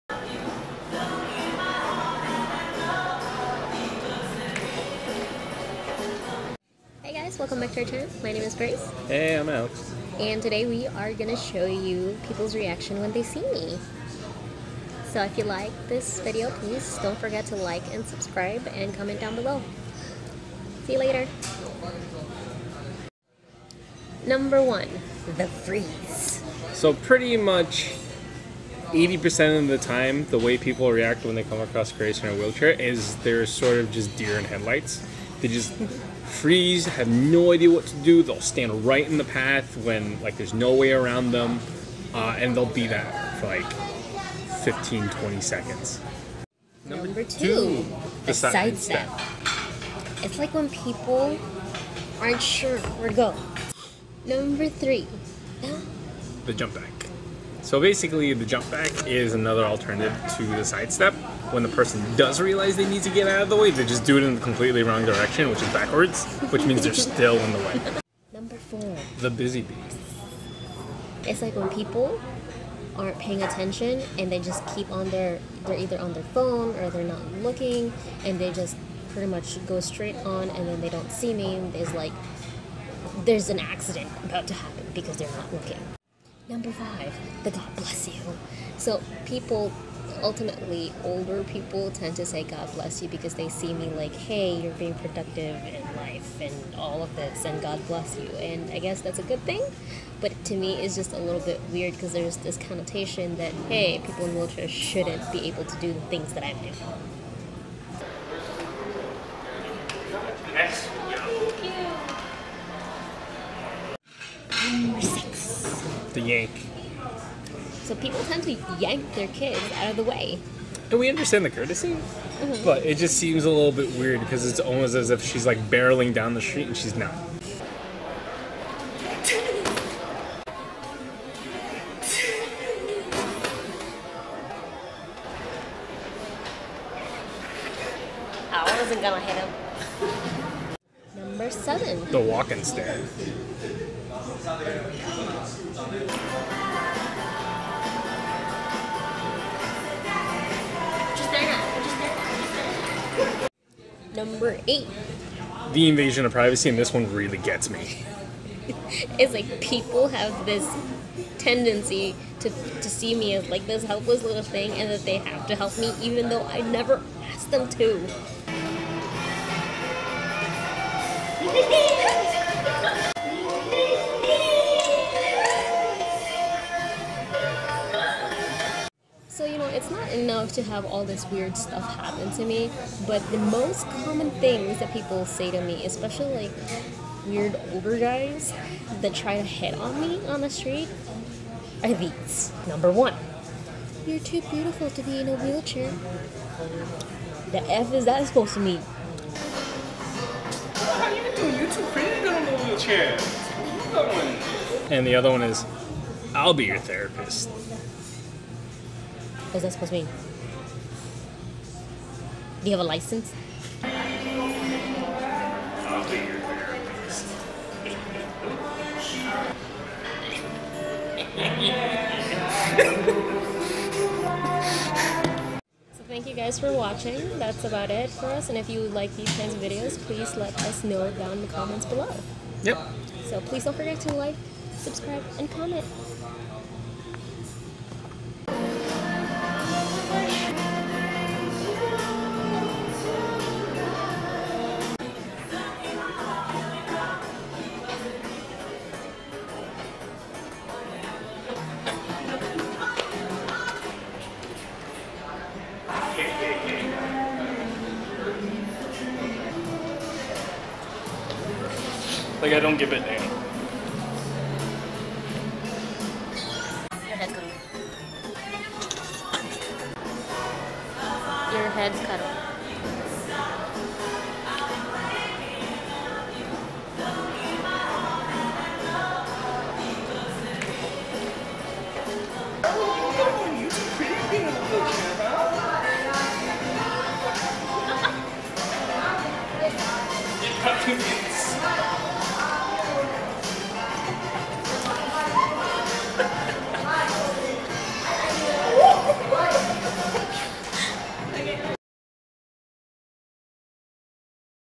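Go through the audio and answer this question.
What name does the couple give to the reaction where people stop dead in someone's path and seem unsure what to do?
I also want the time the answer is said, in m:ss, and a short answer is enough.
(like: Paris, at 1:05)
The freeze, at 0:25.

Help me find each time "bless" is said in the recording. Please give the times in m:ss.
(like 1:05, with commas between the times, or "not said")
1:27, 1:32, 1:37.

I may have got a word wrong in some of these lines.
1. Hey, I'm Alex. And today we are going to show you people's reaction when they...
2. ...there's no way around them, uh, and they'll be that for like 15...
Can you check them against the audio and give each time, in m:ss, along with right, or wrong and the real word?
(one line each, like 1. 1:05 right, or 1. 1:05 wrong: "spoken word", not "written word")
1. 0:09 right
2. 0:40 right.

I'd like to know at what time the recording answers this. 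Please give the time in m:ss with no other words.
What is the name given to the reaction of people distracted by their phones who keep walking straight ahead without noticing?
1:09.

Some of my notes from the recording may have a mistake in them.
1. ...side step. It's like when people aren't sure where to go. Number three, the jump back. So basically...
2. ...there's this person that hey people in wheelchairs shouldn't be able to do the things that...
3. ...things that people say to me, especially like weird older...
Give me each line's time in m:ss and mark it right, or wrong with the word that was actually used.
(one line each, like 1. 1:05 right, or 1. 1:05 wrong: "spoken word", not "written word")
1. 0:48 right
2. 1:42 wrong: "connotation", not "person"
3. 3:04 right.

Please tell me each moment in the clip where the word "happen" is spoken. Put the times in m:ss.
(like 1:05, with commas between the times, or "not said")
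1:24, 3:01.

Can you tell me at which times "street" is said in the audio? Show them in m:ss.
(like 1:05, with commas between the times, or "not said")
2:06, 3:10.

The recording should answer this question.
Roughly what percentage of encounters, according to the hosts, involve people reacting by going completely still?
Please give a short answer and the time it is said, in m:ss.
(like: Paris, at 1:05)
80%, at 0:28.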